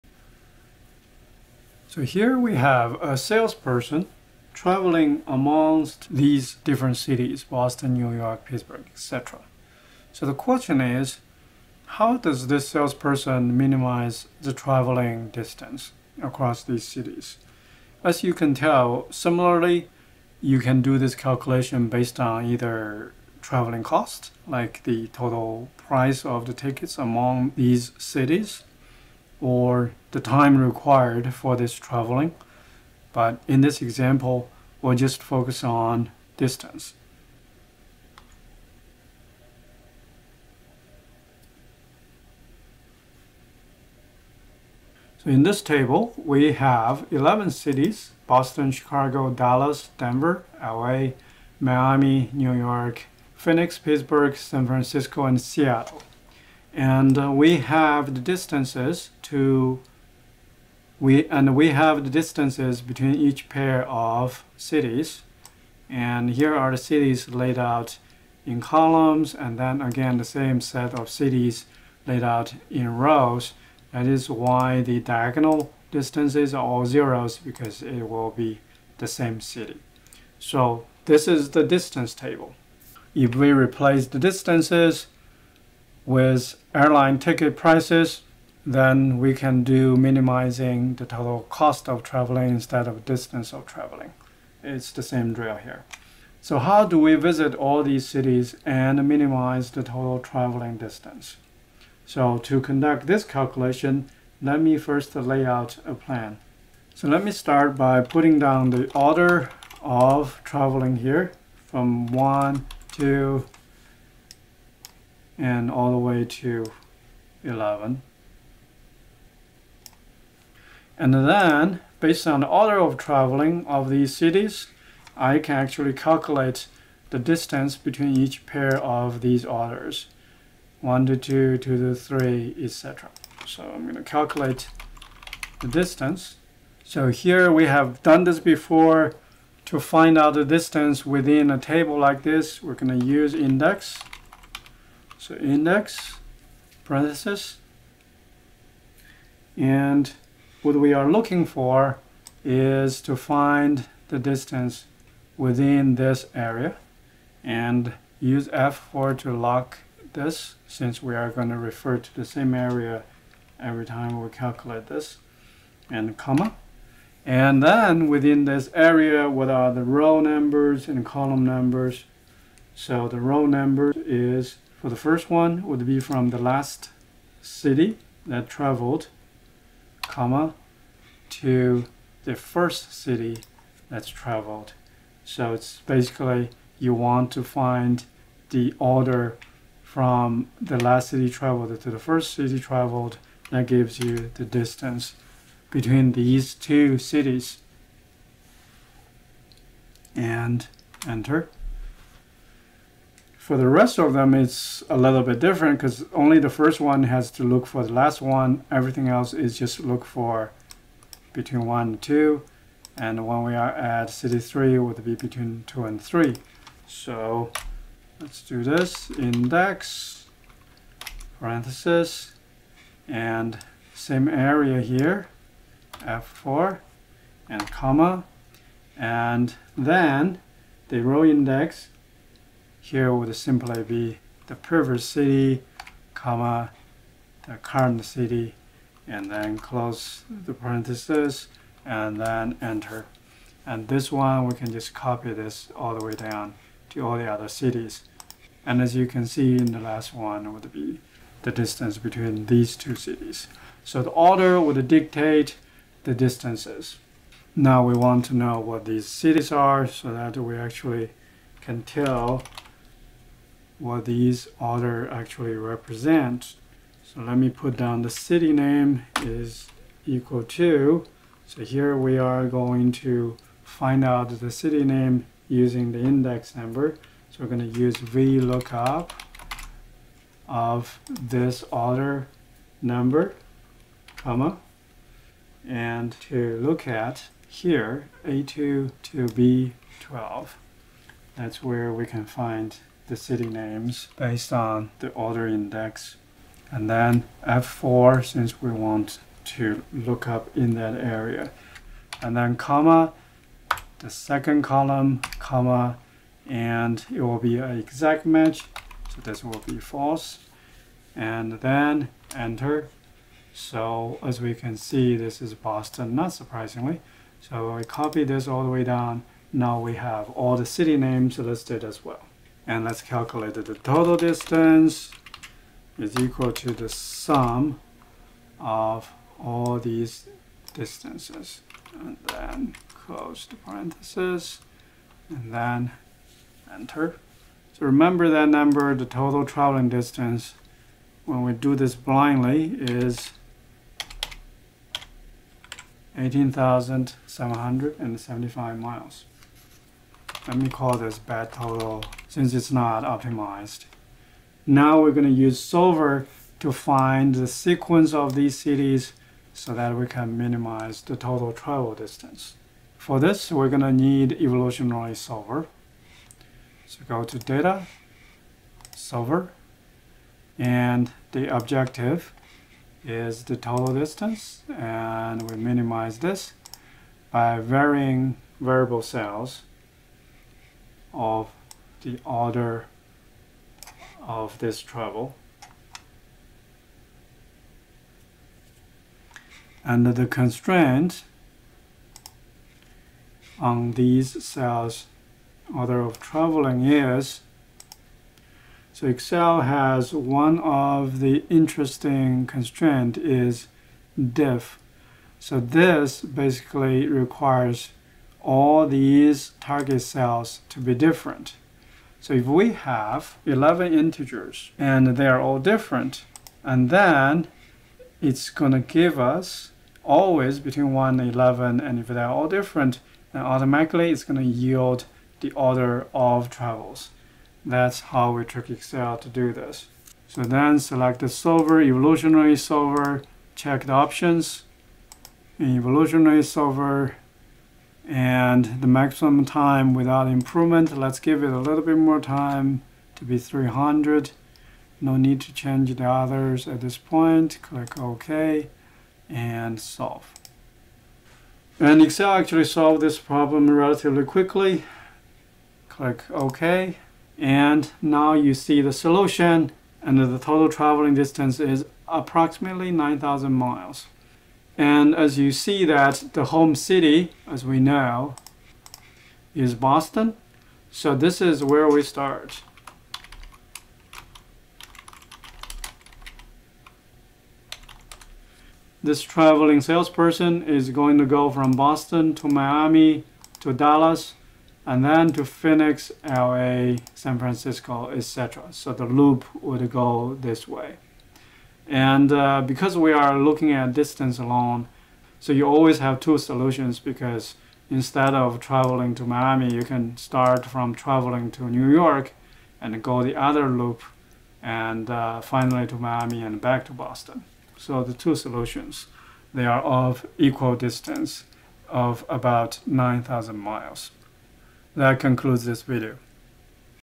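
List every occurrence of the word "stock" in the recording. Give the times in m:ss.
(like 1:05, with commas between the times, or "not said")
not said.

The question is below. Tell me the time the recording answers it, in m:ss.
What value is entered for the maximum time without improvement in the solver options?
7:23.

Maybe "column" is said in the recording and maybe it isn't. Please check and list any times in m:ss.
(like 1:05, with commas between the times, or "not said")
1:08, 2:51, 5:04.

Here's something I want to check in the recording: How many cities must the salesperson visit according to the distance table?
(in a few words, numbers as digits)
11.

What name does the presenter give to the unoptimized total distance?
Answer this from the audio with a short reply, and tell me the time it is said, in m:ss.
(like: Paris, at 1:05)
bad total, at 5:51.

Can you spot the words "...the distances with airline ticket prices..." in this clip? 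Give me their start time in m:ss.
1:24.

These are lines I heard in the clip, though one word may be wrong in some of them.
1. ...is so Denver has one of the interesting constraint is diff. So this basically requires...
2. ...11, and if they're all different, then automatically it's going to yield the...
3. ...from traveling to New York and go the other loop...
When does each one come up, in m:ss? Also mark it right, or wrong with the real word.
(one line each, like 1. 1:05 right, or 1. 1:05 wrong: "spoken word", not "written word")
1. 6:36 wrong: "Excel", not "Denver"
2. 7:01 right
3. 8:20 right.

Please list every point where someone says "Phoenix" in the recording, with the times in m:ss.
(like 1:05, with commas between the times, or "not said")
0:53, 8:05.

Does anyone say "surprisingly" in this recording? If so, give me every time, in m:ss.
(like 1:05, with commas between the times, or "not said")
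5:16.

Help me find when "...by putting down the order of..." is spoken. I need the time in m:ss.
1:47.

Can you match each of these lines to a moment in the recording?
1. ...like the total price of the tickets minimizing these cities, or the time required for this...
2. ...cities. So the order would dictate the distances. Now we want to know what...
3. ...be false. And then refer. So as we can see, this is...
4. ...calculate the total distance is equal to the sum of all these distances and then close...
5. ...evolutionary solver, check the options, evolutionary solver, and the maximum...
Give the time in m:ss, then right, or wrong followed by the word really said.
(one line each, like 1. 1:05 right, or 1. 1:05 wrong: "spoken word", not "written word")
1. 0:24 wrong: "among", not "minimizing"
2. 4:12 right
3. 5:09 wrong: "enter", not "refer"
4. 5:23 right
5. 7:11 right.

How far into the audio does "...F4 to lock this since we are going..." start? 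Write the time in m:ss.
2:38.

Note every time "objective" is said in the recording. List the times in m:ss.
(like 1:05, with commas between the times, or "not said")
6:11.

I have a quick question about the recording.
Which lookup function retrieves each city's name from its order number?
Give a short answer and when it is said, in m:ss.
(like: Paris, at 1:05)
VLOOKUP, at 4:37.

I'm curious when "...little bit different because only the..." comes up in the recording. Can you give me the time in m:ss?
3:24.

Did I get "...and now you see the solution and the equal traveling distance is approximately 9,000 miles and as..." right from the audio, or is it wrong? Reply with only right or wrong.
wrong.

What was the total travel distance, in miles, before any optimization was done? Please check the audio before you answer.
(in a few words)
18,775 miles.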